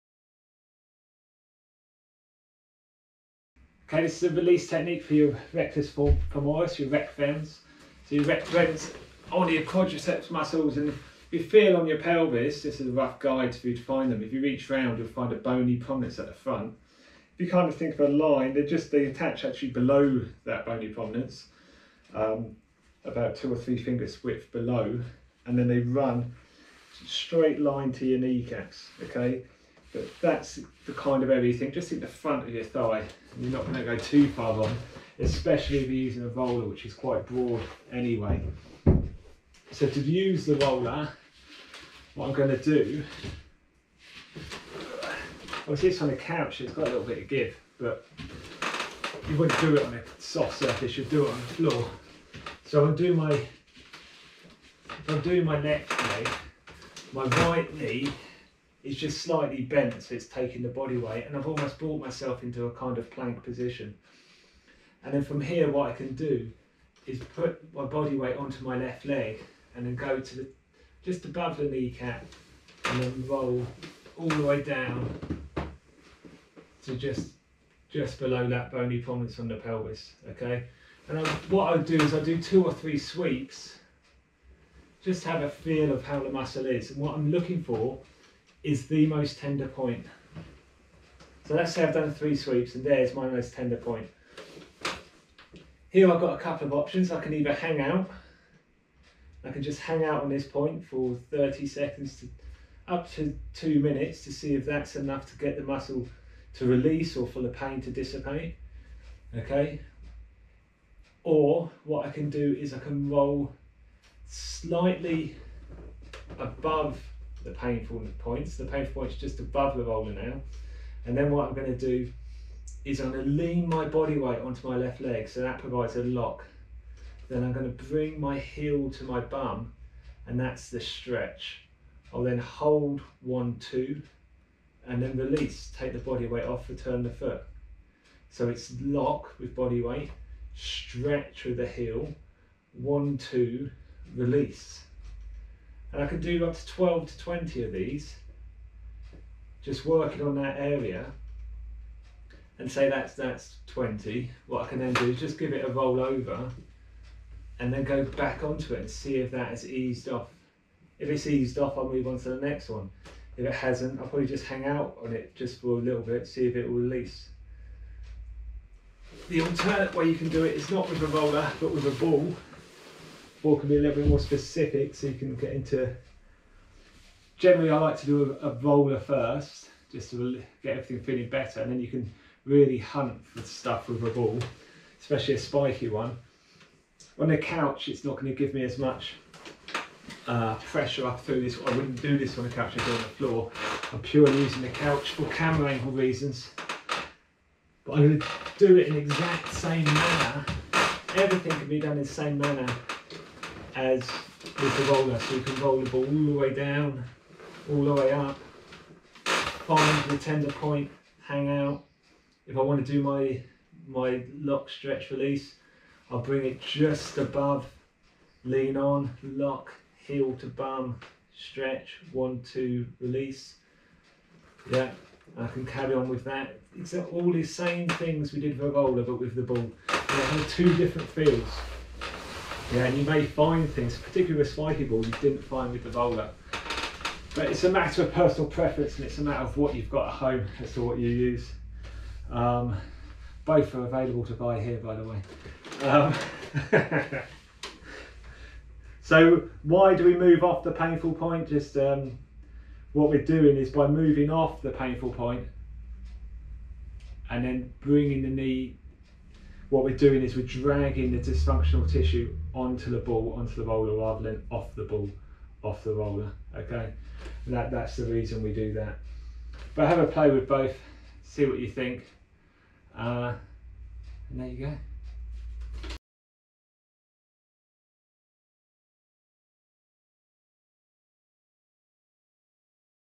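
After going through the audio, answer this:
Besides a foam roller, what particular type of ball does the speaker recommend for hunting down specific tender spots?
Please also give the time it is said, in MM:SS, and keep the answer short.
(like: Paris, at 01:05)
spiky ball, at 03:05.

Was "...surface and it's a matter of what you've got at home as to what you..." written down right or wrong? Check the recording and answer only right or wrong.
wrong.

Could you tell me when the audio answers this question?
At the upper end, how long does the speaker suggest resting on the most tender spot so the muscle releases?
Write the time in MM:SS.
01:43.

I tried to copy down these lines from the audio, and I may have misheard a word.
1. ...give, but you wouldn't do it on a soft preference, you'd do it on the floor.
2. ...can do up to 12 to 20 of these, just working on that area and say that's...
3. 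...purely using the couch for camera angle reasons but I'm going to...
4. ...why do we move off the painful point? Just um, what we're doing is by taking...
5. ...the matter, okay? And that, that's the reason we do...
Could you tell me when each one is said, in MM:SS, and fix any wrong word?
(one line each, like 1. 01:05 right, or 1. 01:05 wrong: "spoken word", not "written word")
1. 00:47 wrong: "surface", not "preference"
2. 02:26 right
3. 03:13 right
4. 04:09 wrong: "moving", not "taking"
5. 04:25 wrong: "roller", not "matter".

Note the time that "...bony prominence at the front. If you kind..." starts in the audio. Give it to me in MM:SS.
00:15.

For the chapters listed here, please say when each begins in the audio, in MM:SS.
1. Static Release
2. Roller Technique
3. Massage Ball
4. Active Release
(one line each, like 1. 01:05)
1. 01:35
2. 00:40
3. 02:50
4. 01:50.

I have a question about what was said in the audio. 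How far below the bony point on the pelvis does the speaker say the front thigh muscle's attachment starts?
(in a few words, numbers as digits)
2 or 3 fingers width.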